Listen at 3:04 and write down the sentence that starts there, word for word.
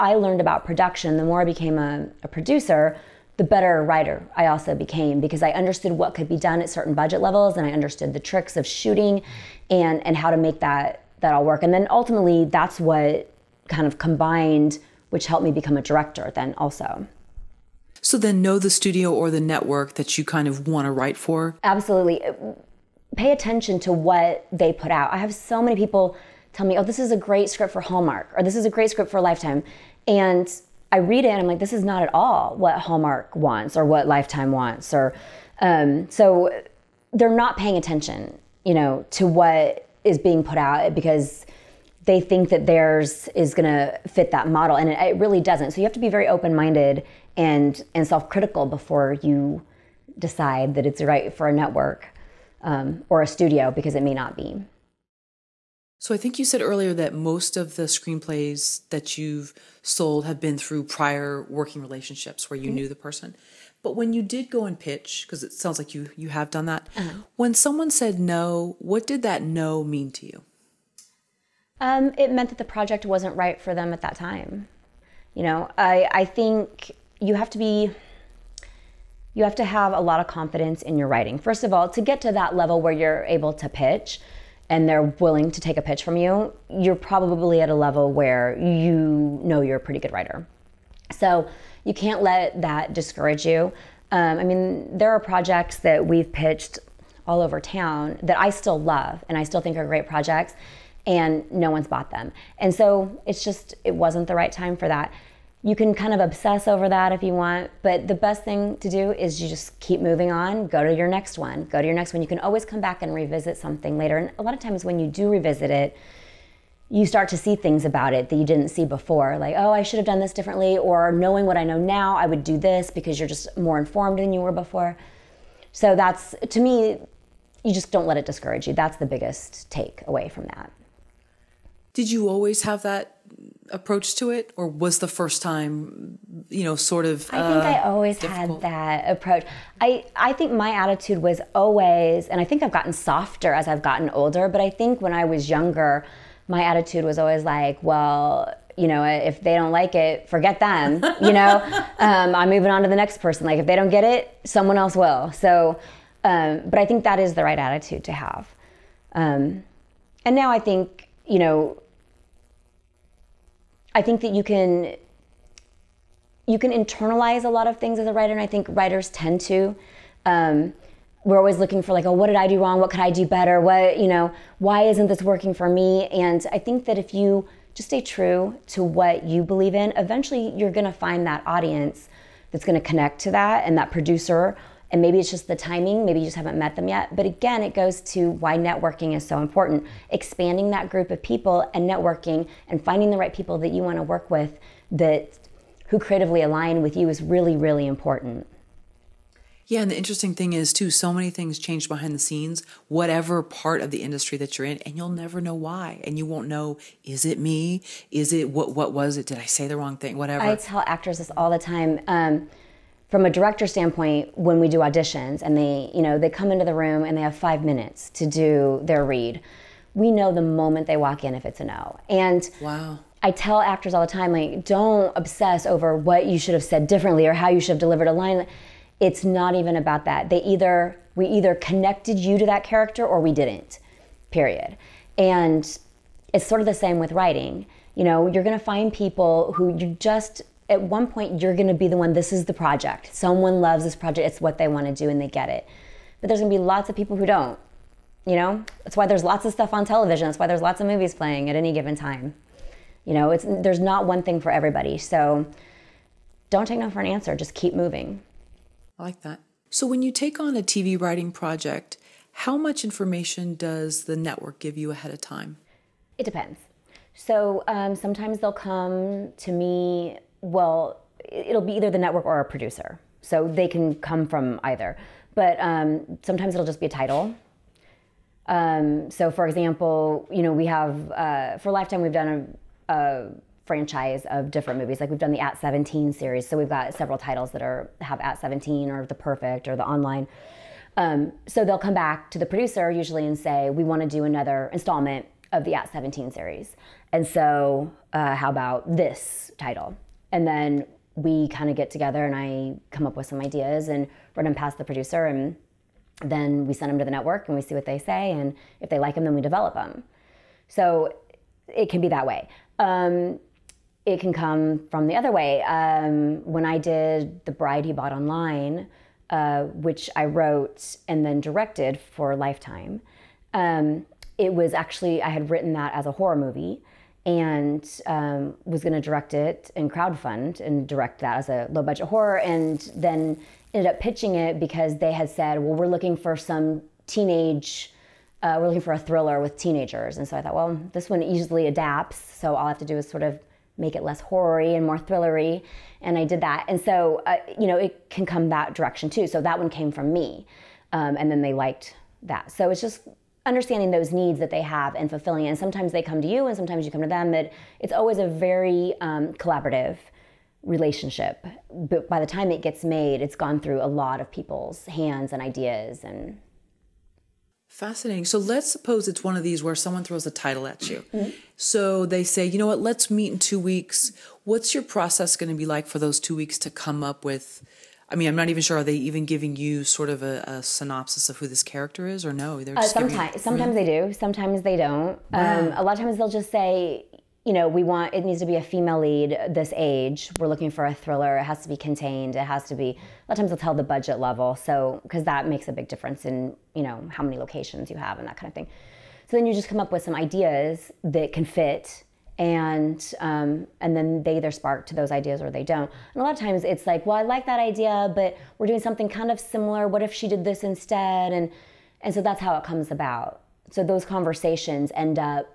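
And maybe it's just the timing, maybe you just haven't met them yet.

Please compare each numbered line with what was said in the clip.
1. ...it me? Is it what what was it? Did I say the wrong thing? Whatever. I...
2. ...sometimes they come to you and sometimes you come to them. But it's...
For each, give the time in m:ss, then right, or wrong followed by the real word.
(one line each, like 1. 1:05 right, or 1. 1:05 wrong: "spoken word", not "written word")
1. 3:27 right
2. 5:55 right.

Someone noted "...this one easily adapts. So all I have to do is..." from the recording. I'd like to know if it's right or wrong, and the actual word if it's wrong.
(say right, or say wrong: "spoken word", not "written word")
right.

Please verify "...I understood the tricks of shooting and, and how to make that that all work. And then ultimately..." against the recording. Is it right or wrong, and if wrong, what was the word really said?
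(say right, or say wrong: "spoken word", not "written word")
right.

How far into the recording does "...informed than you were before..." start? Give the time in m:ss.
2:03.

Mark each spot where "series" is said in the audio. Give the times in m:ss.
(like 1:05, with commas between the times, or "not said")
4:46, 4:56.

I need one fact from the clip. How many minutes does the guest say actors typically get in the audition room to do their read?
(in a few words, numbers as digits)
5.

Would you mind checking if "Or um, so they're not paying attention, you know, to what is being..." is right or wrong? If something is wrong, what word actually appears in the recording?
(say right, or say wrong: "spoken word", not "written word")
right.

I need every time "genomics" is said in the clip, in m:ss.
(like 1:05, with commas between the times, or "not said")
not said.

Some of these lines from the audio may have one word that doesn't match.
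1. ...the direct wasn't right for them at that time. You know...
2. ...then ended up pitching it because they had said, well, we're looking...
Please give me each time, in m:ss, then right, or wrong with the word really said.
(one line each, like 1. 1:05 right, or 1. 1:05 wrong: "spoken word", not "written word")
1. 1:12 wrong: "project", not "direct"
2. 5:32 right.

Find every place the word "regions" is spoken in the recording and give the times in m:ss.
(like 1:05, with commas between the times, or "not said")
not said.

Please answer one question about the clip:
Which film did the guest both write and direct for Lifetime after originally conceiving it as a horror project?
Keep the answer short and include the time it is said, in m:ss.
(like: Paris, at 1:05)
The Bride He Bought Online, at 5:17.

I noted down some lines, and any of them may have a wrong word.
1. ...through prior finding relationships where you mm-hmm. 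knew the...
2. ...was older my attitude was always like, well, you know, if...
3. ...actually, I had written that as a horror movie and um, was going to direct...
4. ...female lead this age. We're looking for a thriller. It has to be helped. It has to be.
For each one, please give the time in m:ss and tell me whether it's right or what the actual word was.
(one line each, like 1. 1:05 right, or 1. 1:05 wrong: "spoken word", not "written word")
1. 1:00 wrong: "working", not "finding"
2. 2:25 wrong: "younger", not "older"
3. 5:24 right
4. 6:28 wrong: "contained", not "helped".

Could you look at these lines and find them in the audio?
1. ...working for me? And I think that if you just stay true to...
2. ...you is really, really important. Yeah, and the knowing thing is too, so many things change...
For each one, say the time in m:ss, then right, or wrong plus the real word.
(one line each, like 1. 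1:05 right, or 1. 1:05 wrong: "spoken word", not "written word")
1. 2:55 right
2. 3:16 wrong: "interesting", not "knowing".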